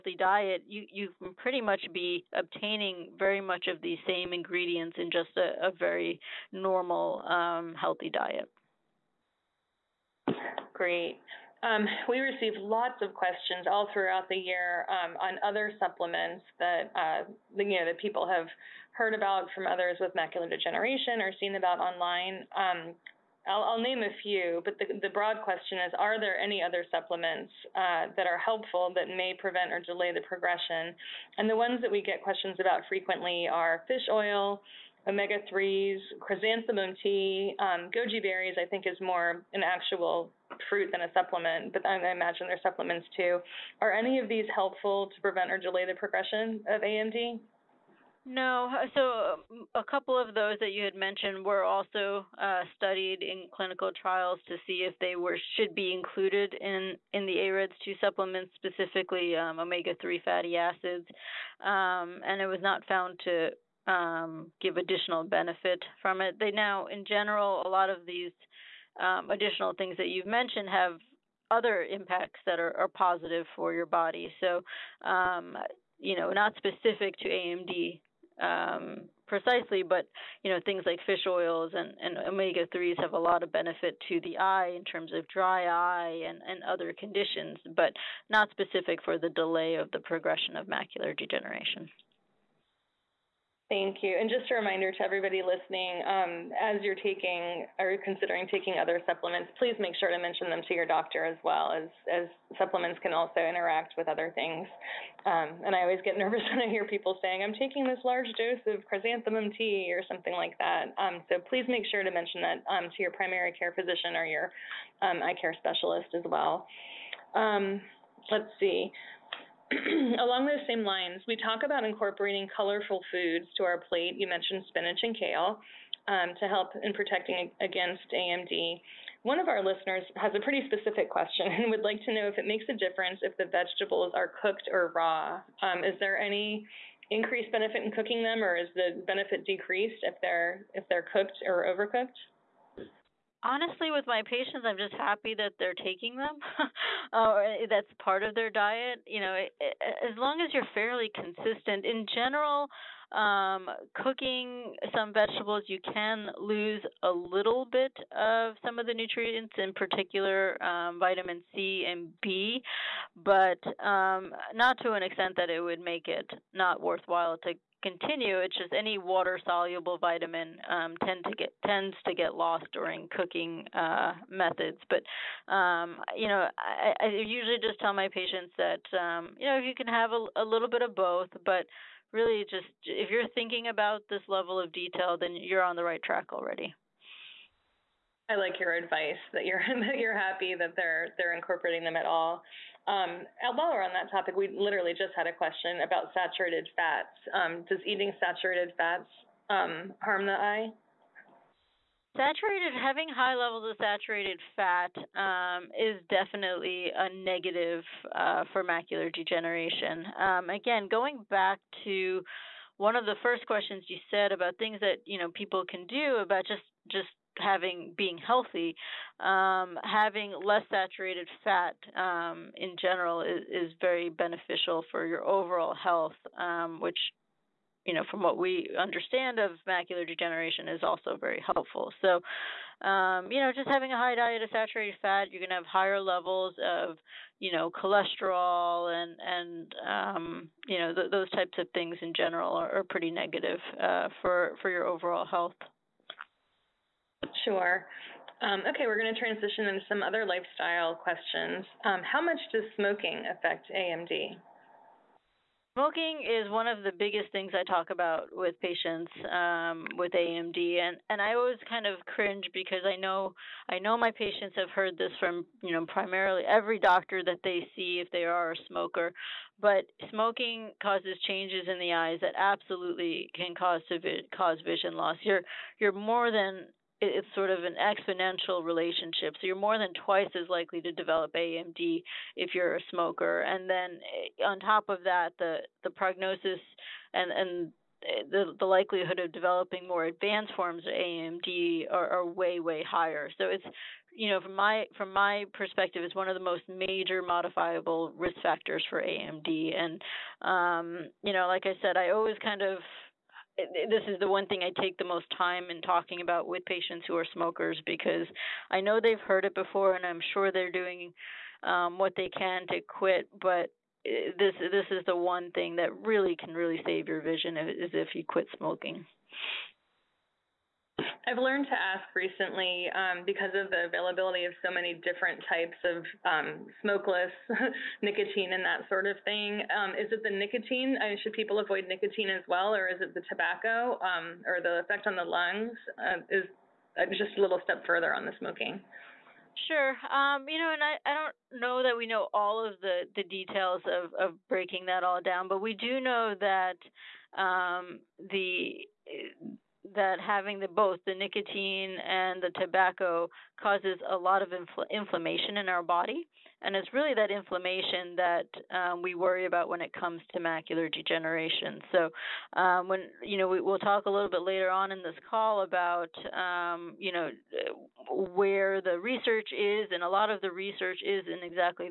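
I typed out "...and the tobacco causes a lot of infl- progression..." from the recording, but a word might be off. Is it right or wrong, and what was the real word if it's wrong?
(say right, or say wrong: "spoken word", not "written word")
wrong: "inflammation", not "progression".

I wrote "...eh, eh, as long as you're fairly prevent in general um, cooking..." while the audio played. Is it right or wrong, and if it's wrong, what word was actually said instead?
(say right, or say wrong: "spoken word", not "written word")
wrong: "consistent", not "prevent".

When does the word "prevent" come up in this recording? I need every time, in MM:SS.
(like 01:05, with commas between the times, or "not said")
00:29, 00:45.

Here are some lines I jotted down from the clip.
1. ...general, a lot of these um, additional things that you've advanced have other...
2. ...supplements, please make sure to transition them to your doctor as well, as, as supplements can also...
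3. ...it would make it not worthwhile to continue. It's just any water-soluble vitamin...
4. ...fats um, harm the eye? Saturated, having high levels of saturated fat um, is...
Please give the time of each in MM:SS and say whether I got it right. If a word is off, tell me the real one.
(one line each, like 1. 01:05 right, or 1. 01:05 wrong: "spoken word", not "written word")
1. 01:07 wrong: "mentioned", not "advanced"
2. 01:39 wrong: "mention", not "transition"
3. 02:45 right
4. 03:18 right.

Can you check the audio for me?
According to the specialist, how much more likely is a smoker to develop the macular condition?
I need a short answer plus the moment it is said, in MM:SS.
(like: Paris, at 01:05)
twice as likely, at 04:40.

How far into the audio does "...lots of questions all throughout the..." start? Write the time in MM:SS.
00:12.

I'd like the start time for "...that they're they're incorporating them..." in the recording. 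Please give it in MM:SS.
03:10.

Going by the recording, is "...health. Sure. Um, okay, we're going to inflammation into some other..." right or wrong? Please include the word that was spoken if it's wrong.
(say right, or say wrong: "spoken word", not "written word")
wrong: "transition", not "inflammation".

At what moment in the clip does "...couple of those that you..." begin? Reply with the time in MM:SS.
00:49.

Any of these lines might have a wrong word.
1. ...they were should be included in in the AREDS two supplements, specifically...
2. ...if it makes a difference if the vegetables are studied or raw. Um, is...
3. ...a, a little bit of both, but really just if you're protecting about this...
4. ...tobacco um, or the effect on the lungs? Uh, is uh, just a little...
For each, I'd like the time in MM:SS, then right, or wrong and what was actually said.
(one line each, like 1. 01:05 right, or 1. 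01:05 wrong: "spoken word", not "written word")
1. 00:55 right
2. 02:12 wrong: "cooked", not "studied"
3. 03:00 wrong: "thinking", not "protecting"
4. 05:33 right.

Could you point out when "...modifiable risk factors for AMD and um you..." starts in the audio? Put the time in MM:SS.
04:57.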